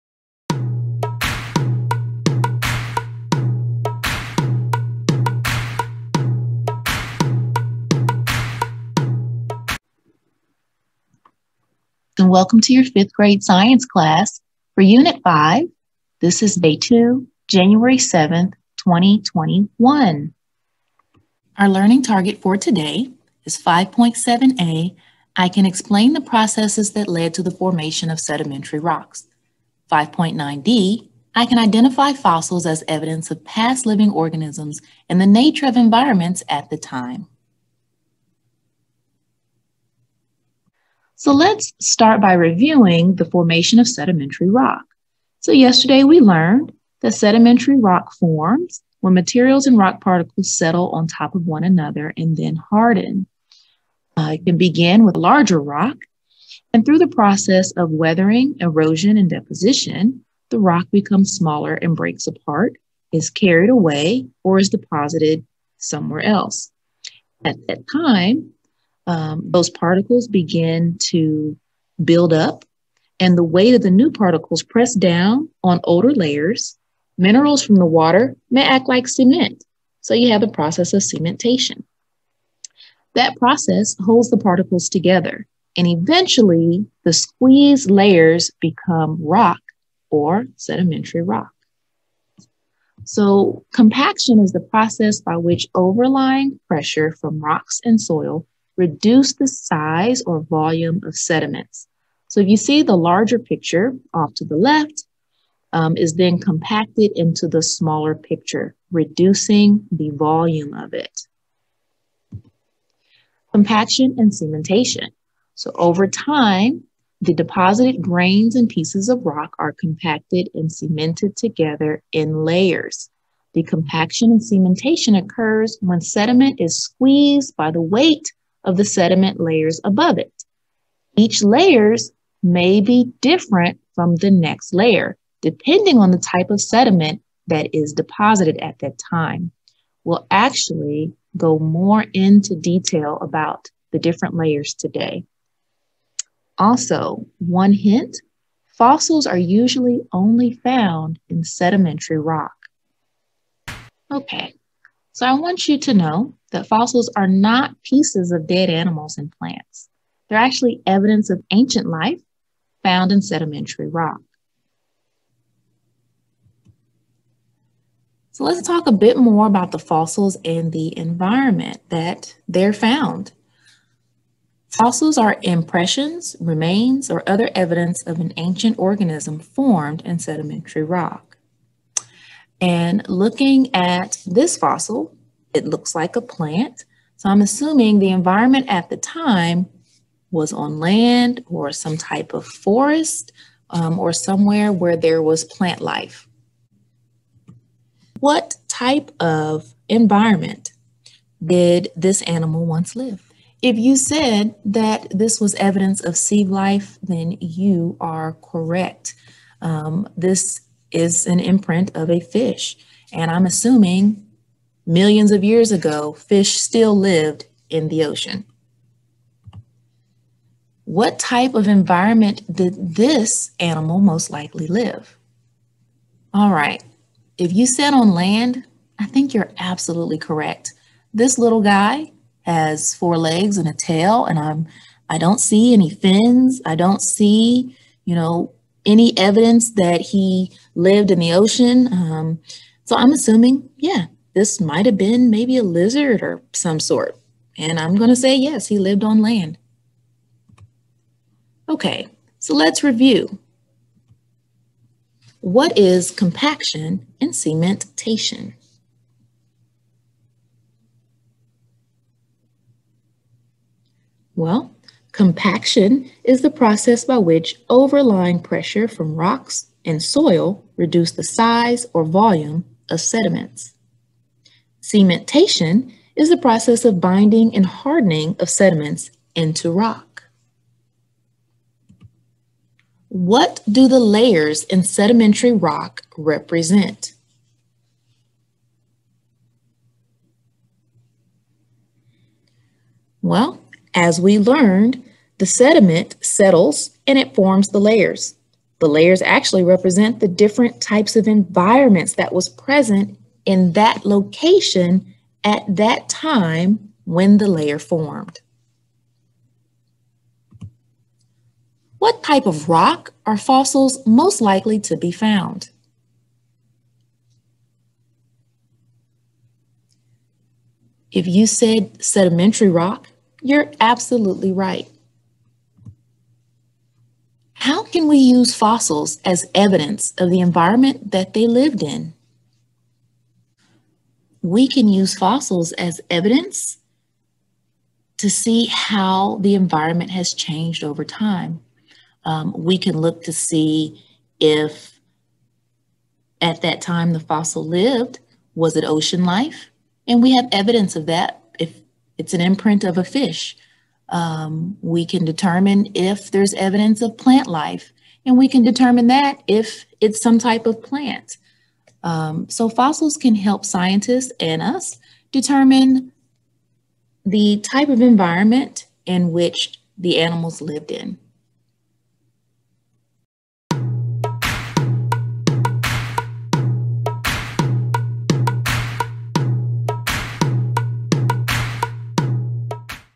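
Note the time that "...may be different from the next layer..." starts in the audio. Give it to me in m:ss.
2:12.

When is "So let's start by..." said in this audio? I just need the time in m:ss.
0:41.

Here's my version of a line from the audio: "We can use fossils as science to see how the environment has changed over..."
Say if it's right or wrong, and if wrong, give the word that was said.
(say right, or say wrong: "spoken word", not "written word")
wrong: "evidence", not "science".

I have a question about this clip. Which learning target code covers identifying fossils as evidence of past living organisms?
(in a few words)
5.9d.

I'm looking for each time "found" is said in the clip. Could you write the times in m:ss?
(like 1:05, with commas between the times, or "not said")
2:30, 2:42, 2:52, 5:15.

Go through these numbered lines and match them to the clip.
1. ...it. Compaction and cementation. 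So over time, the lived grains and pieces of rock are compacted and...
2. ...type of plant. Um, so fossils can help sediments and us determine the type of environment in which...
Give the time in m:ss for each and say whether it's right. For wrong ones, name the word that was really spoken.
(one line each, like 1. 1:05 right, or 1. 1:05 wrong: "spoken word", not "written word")
1. 1:50 wrong: "deposited", not "lived"
2. 6:00 wrong: "scientists", not "sediments".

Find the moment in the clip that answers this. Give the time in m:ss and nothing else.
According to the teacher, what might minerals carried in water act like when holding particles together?
1:18.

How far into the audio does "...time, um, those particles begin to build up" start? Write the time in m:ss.
1:07.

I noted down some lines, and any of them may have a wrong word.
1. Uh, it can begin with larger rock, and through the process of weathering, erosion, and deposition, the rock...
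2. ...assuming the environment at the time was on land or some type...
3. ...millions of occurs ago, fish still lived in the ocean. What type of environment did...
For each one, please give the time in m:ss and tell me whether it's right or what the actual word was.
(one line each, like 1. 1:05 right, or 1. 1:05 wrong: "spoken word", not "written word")
1. 0:54 right
2. 3:07 right
3. 3:34 wrong: "years", not "occurs".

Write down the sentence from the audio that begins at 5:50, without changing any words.
And we have evidence of that if it's an imprint of a fish.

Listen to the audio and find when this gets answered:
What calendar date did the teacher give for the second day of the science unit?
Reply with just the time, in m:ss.
0:17.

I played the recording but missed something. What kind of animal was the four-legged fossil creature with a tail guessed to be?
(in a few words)
a lizard.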